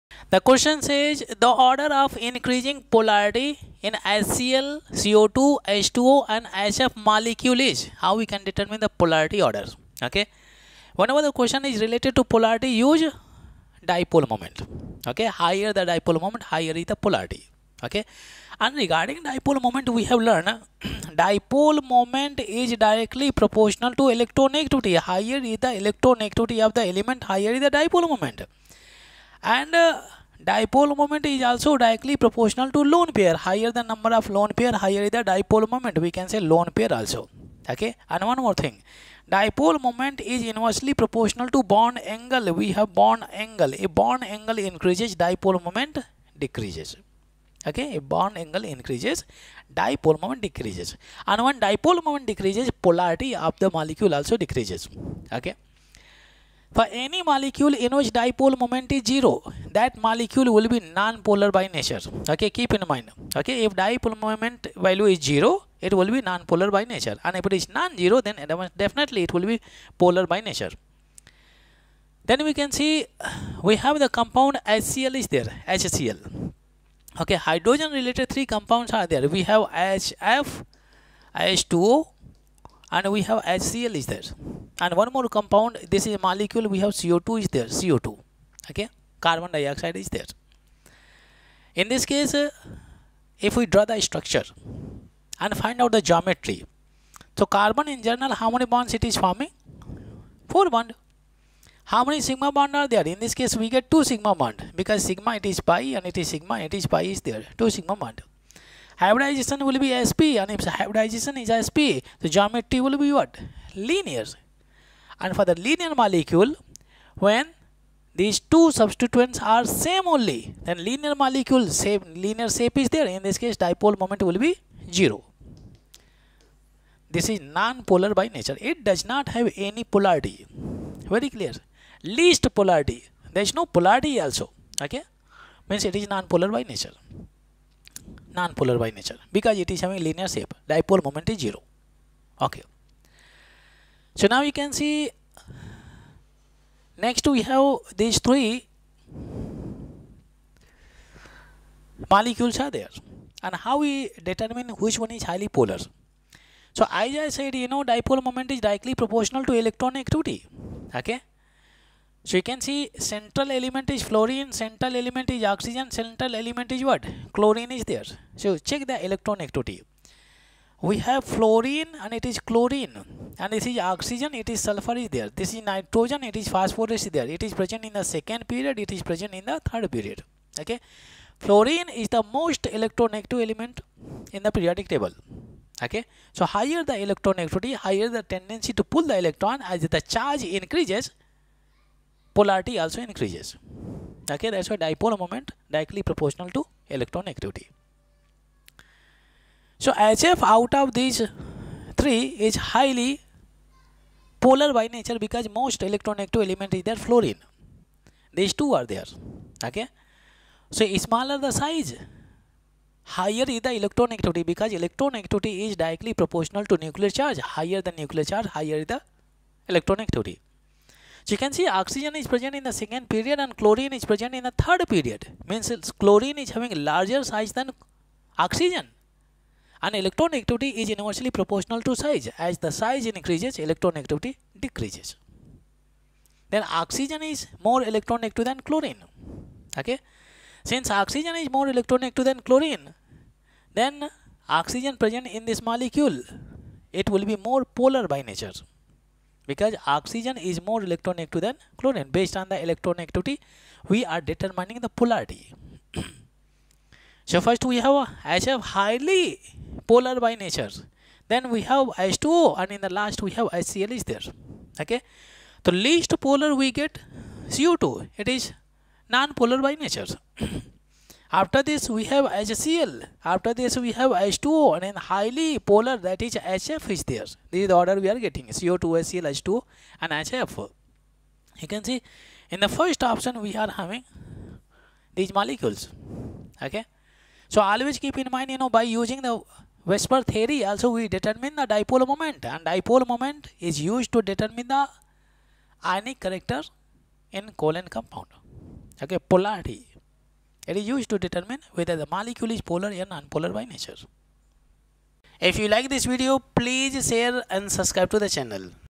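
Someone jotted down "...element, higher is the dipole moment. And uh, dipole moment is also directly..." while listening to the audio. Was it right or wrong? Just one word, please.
right.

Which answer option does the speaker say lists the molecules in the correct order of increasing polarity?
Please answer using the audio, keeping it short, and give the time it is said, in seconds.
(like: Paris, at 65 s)
First option, at 282 s.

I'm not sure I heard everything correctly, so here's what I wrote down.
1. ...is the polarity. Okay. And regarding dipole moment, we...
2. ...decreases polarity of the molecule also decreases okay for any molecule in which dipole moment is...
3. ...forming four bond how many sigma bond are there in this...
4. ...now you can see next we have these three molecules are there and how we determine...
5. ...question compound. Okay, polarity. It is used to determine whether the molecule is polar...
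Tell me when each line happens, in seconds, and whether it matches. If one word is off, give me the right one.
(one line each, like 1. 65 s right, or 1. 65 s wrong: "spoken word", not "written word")
1. 16 s right
2. 52 s right
3. 99 s right
4. 144 s right
5. 297 s wrong: "colon", not "question".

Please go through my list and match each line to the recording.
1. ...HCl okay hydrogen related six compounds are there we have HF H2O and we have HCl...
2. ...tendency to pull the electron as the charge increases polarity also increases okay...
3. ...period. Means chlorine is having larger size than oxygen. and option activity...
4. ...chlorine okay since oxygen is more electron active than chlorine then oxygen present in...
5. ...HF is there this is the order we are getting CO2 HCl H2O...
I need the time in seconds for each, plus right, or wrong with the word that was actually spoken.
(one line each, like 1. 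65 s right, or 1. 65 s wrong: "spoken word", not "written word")
1. 75 s wrong: "three", not "six"
2. 188 s right
3. 224 s wrong: "electron", not "option"
4. 238 s right
5. 276 s right.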